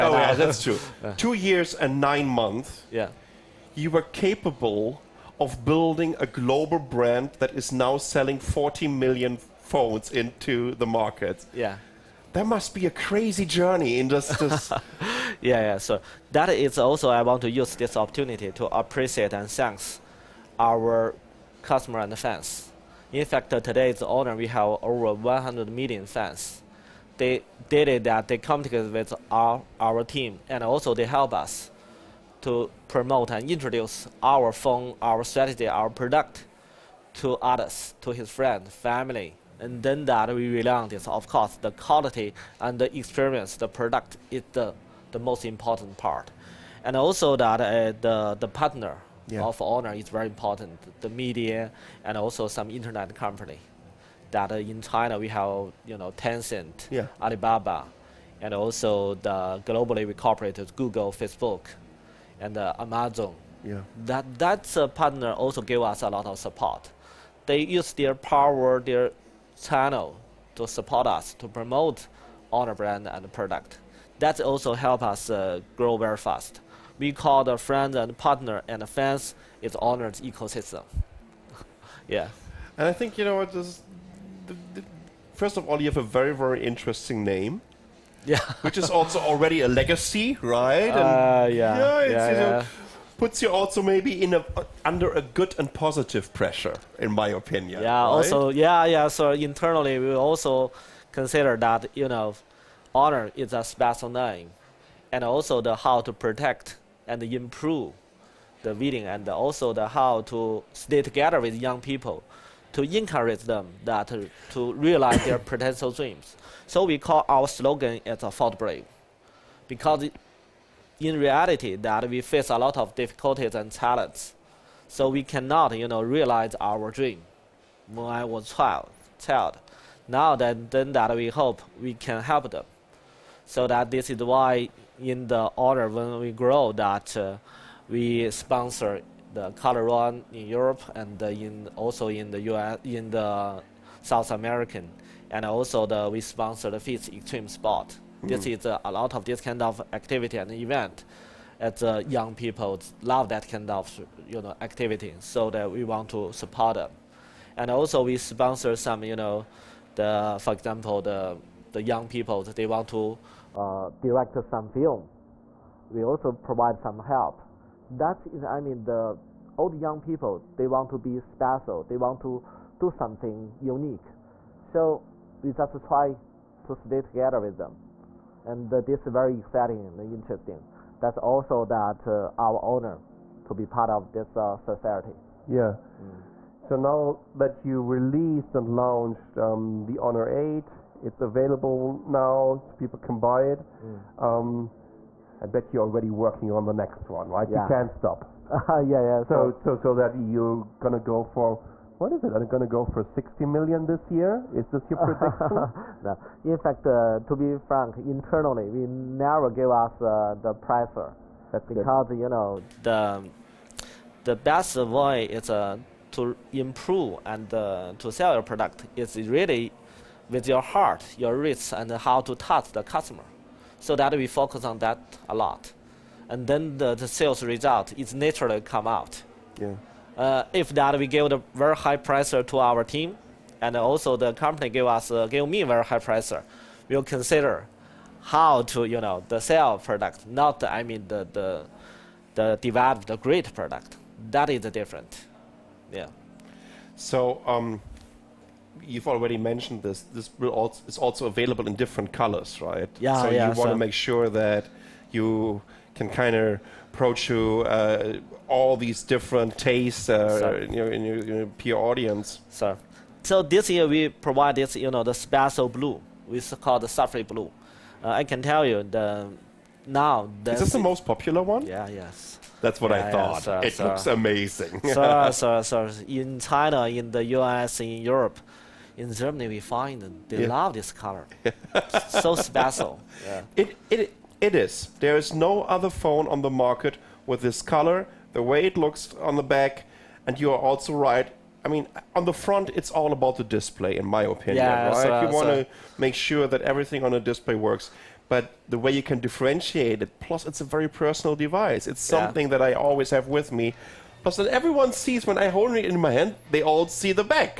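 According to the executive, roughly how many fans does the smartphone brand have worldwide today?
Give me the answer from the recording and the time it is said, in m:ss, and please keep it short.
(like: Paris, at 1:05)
over 100 million, at 0:24.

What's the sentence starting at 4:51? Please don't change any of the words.
I mean, on the front, it's all about the display, in my opinion.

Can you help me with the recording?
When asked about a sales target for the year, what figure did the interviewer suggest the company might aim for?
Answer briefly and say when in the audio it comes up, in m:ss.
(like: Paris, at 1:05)
60 million, at 3:23.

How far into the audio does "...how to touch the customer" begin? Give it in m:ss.
3:41.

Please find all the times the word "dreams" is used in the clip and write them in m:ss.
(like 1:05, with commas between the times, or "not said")
1:55, 2:06.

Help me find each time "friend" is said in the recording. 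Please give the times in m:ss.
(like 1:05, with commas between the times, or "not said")
0:38, 1:17.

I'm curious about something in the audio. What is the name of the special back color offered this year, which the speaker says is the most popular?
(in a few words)
Sapphire Blue.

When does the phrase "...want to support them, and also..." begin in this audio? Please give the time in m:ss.
2:35.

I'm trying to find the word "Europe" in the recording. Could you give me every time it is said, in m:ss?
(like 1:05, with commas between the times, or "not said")
2:20, 4:38.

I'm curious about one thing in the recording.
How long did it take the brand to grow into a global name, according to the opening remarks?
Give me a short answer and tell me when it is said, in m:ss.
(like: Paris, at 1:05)
two years and nine months, at 0:01.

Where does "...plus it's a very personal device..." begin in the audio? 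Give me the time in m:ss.
5:00.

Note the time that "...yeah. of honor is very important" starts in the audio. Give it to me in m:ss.
0:49.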